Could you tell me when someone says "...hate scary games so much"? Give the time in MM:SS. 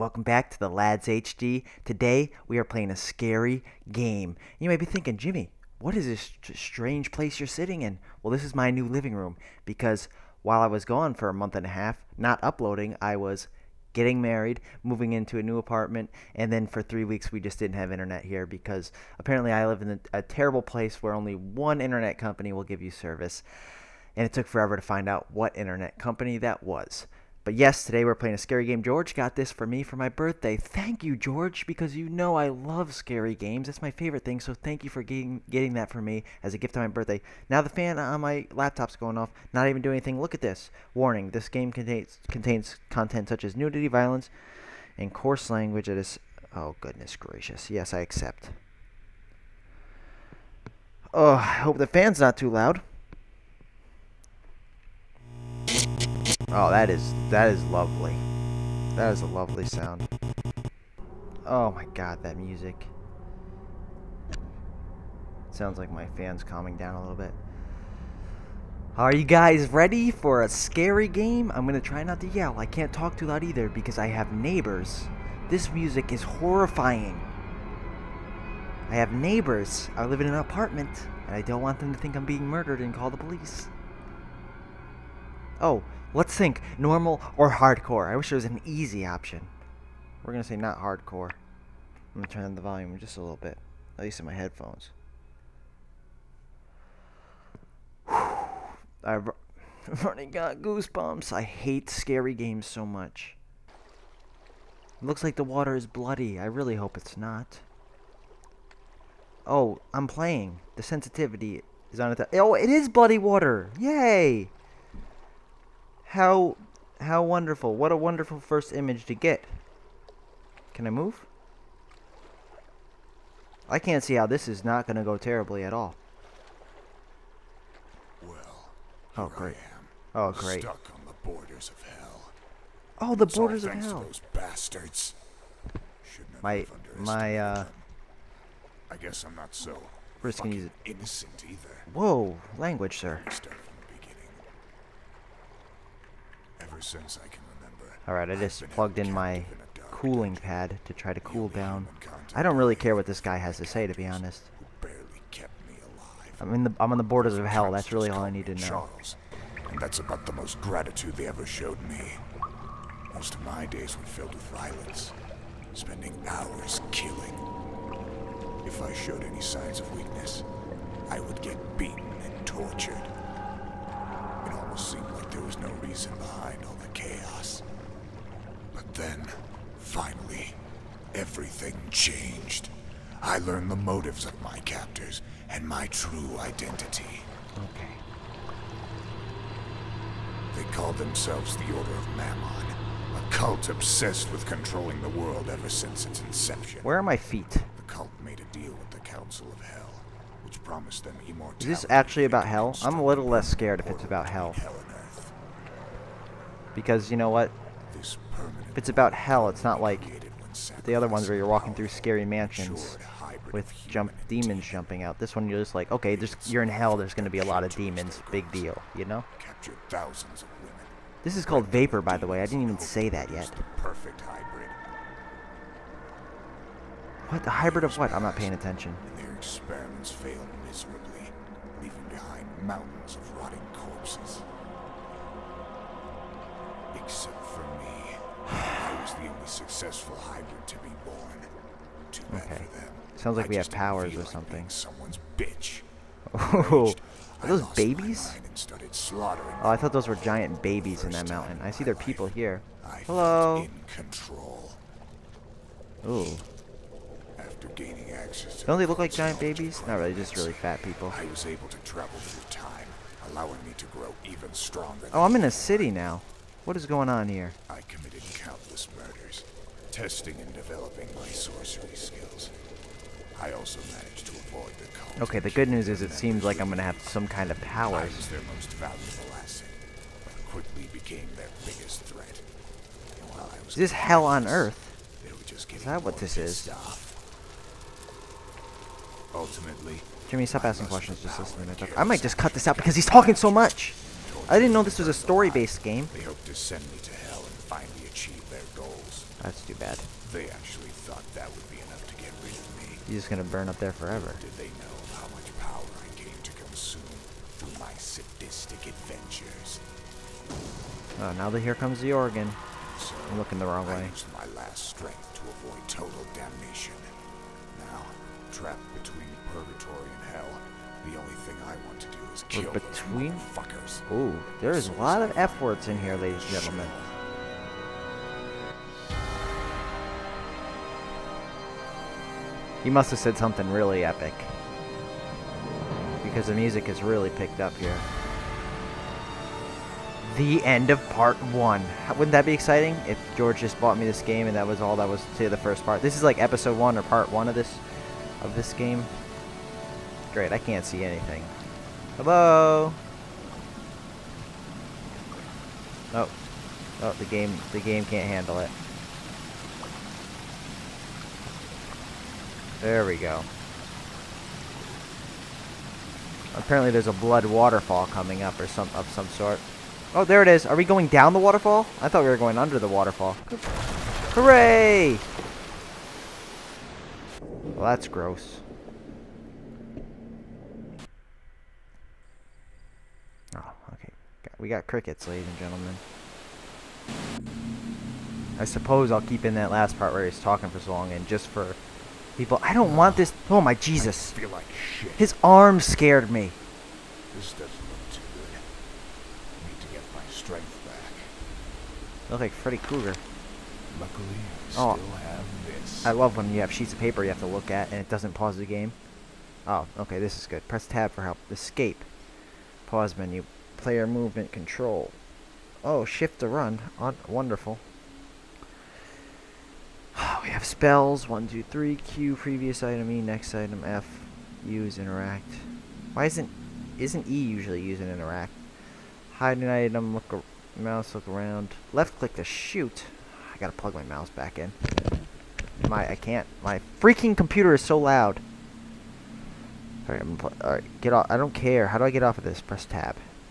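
01:41.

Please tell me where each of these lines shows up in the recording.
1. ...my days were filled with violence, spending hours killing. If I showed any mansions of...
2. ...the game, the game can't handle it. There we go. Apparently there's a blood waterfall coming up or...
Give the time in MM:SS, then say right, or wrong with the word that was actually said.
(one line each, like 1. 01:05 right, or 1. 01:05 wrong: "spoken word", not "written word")
1. 02:43 wrong: "signs", not "mansions"
2. 05:57 right.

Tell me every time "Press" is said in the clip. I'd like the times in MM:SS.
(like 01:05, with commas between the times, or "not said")
06:50, 07:22.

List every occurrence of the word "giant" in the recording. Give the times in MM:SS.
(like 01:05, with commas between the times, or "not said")
04:10, 04:19.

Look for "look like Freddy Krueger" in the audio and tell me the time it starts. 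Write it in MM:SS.
06:42.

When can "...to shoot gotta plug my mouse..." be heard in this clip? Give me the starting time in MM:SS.
07:12.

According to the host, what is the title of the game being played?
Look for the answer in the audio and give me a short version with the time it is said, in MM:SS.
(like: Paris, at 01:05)
Vapour, at 03:41.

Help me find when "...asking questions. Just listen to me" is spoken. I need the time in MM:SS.
04:50.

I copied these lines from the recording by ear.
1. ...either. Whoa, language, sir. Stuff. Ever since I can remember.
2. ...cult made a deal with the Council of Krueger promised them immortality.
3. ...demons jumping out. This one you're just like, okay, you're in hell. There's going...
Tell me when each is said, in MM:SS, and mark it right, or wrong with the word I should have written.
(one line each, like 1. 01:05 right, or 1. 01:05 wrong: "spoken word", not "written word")
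1. 02:21 right
2. 03:17 wrong: "Hell", not "Krueger"
3. 03:34 right.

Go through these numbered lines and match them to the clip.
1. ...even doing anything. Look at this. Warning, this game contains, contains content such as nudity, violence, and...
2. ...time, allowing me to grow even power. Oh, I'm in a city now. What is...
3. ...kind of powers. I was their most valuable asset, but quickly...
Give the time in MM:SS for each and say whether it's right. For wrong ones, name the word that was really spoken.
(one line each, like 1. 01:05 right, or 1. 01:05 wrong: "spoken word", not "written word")
1. 00:39 right
2. 04:22 wrong: "stronger", not "power"
3. 04:37 right.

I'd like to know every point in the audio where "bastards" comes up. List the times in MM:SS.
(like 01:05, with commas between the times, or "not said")
02:14.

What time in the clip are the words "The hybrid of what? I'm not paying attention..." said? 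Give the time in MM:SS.
03:47.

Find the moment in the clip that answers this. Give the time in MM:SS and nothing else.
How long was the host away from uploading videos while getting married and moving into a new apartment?
00:11.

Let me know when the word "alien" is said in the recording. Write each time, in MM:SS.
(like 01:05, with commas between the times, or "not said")
not said.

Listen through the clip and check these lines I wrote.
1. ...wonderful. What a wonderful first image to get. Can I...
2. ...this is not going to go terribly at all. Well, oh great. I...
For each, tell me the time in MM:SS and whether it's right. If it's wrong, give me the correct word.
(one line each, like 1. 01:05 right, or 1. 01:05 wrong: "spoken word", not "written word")
1. 01:57 right
2. 02:04 right.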